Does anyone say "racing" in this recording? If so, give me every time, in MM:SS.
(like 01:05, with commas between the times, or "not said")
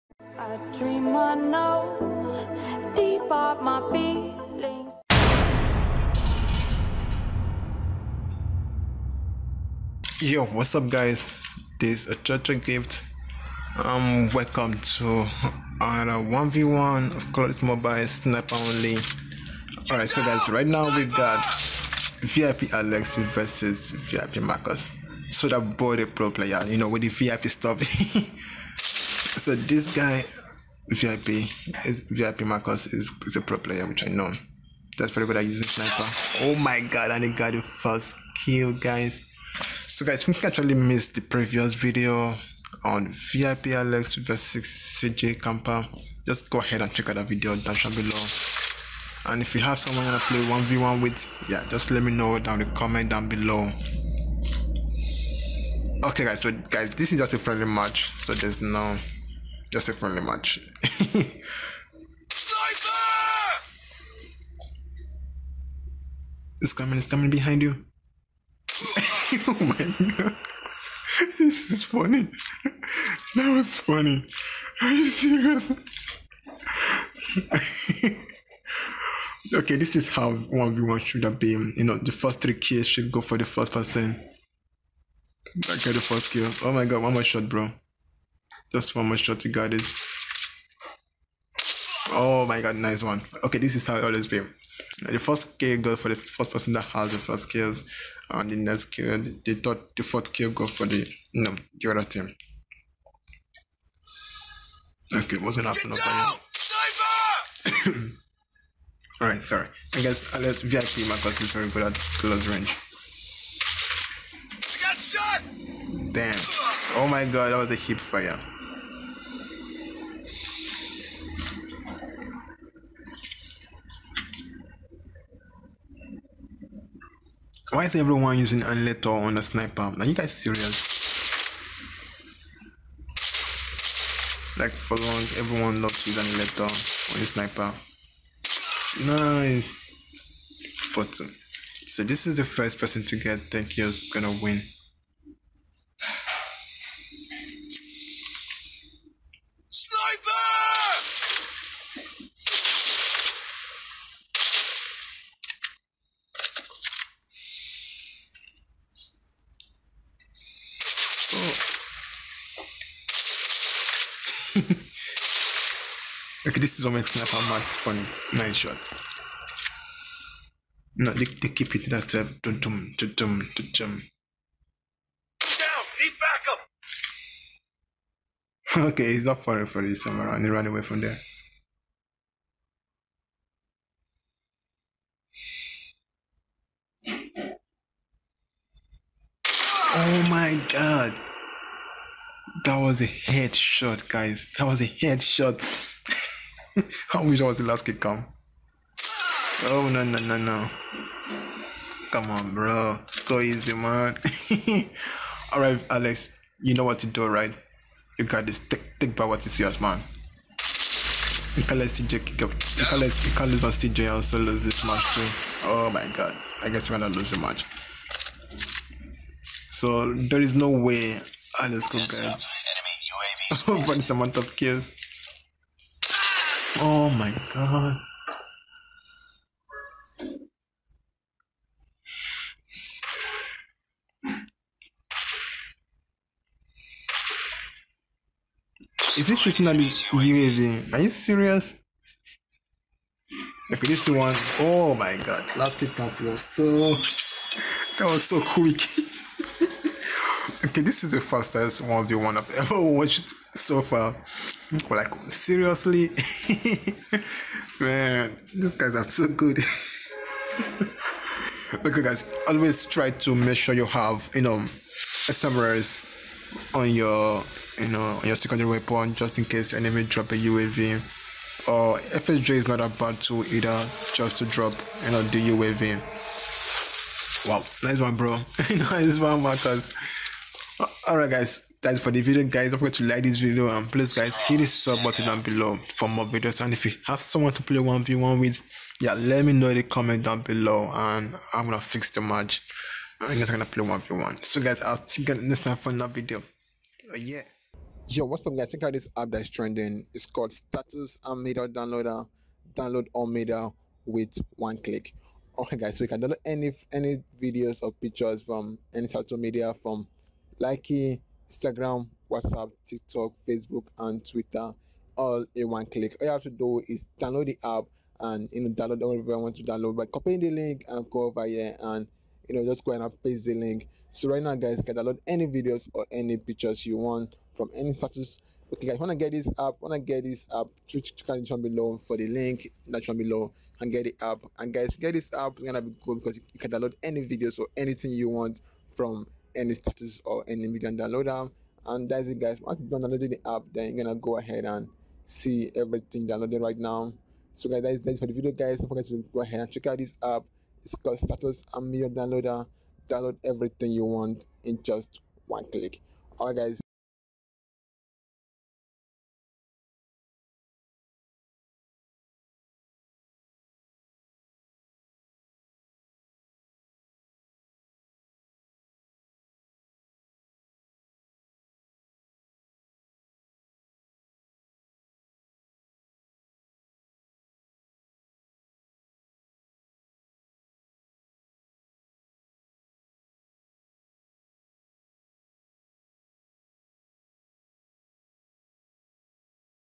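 not said.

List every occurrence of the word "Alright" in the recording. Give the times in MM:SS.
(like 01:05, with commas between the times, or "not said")
00:19, 01:49, 03:25, 04:41, 05:05.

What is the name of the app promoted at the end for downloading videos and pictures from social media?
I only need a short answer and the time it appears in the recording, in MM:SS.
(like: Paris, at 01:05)
Status Media Downloader, at 05:00.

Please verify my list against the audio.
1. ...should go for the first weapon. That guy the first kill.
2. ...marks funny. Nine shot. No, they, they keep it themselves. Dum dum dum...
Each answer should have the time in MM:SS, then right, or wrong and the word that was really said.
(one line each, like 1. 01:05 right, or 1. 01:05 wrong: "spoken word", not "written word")
1. 01:22 wrong: "person", not "weapon"
2. 02:47 right.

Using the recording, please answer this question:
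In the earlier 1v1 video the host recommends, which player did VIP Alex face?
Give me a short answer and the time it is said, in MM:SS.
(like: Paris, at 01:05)
CJ Camper, at 00:44.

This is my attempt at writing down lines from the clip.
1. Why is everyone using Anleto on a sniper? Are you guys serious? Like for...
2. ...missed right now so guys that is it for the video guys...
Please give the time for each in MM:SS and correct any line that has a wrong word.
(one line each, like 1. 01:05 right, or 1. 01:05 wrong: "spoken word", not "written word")
1. 02:07 right
2. 05:46 wrong: "downloaded", not "missed".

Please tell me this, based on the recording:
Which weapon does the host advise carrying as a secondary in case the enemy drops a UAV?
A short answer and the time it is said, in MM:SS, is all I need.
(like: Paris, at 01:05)
SMRS, at 04:25.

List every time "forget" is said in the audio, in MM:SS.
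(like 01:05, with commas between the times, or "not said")
04:42, 05:48.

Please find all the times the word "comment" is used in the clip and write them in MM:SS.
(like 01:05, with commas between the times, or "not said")
00:52, 04:49.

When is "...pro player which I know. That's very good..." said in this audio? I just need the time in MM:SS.
00:33.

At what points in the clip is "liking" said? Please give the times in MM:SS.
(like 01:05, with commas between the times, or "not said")
05:10.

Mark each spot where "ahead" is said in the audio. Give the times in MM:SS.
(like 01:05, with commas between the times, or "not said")
00:46, 05:44, 05:49.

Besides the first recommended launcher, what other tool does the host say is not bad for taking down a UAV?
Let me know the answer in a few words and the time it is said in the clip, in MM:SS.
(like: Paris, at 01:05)
FHJ, at 04:31.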